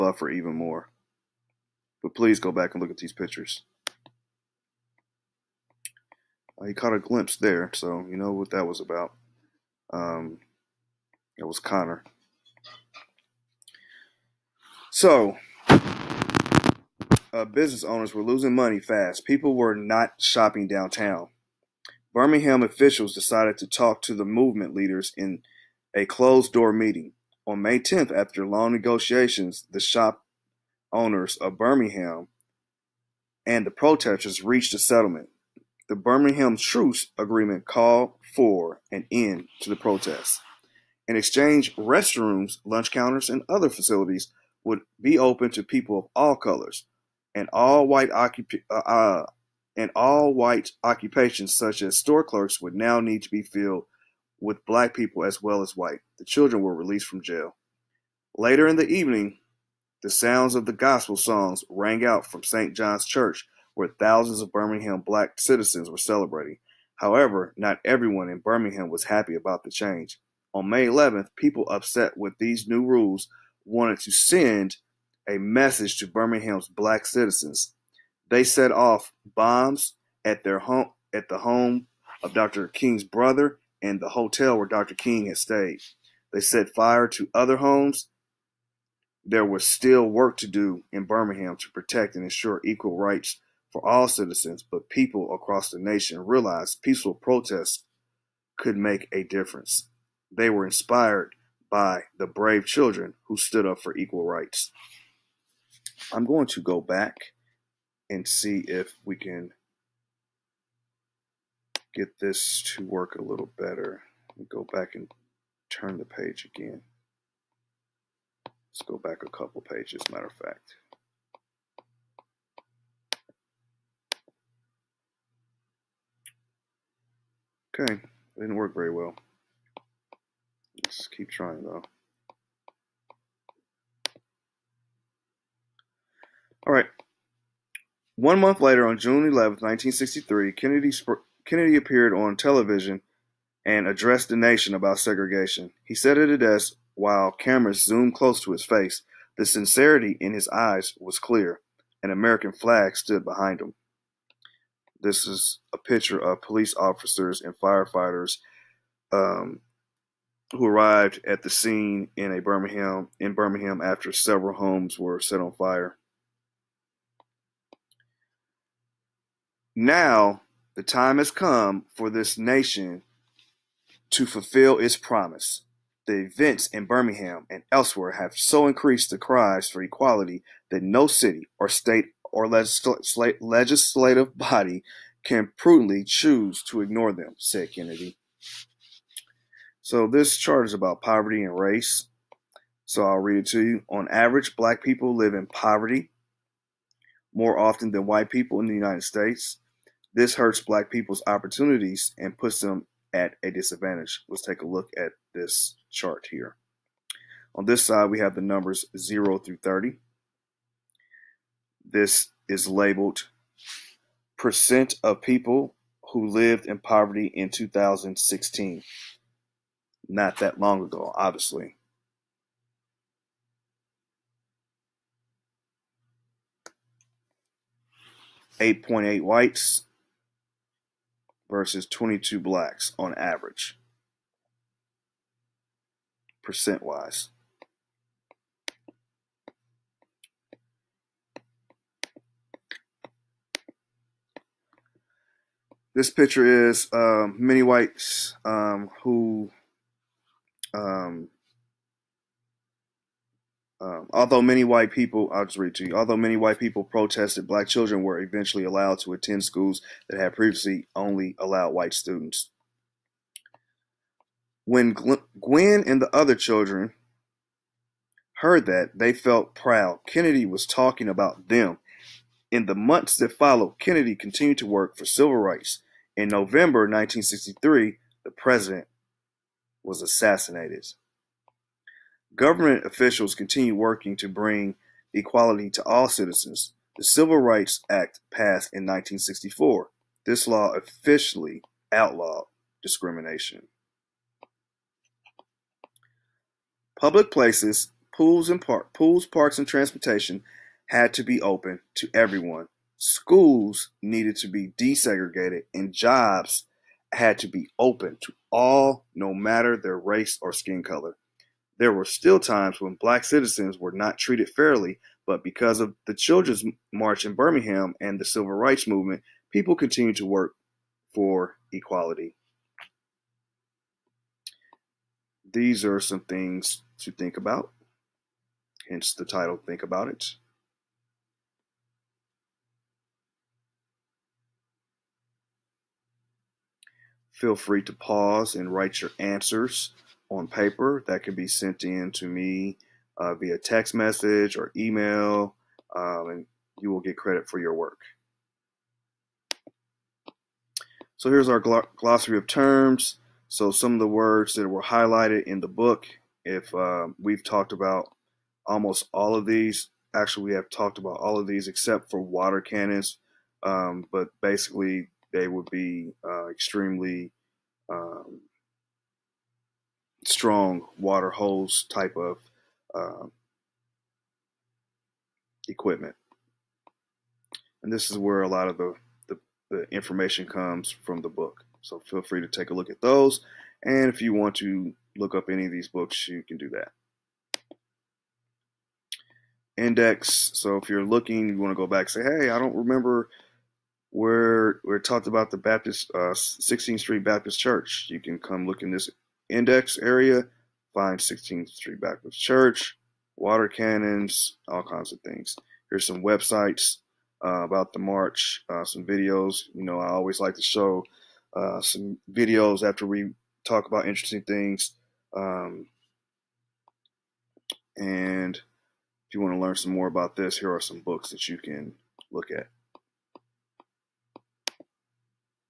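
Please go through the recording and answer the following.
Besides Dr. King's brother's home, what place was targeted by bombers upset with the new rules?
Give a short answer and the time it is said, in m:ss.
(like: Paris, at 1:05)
the hotel where Dr. King had stayed, at 1:24.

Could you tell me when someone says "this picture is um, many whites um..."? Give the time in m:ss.
4:05.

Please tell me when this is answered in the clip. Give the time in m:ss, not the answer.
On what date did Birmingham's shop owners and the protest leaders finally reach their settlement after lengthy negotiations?
0:27.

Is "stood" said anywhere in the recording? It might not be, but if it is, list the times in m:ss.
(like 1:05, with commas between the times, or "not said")
1:43, 2:32.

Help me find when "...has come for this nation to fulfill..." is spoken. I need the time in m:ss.
2:51.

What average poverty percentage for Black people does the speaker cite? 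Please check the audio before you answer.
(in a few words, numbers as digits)
22.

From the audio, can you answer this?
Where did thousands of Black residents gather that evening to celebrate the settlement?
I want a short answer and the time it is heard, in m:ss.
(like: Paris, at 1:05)
St. John's Church, at 1:02.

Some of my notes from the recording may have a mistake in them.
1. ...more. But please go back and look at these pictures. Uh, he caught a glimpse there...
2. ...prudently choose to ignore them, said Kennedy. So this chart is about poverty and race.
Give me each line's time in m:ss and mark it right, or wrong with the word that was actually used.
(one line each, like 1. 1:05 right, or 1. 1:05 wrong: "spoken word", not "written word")
1. 0:00 right
2. 3:05 right.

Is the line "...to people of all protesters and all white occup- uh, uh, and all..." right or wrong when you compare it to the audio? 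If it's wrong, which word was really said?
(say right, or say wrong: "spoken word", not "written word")
wrong: "colors", not "protesters".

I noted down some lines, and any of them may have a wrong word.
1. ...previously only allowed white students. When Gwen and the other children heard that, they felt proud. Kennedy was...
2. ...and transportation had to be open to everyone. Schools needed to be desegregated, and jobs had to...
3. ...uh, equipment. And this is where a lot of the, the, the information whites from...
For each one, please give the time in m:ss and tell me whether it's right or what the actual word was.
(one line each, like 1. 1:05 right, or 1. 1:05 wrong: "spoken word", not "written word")
1. 4:20 right
2. 4:59 right
3. 6:12 wrong: "comes", not "whites".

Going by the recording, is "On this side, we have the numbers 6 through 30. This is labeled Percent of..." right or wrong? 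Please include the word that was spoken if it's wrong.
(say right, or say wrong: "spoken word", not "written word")
wrong: "0", not "6".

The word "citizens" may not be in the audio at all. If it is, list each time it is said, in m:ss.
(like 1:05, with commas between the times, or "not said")
1:05, 1:17, 1:34, 4:46, 5:13.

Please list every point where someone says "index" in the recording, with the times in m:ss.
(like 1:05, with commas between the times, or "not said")
6:29, 6:39.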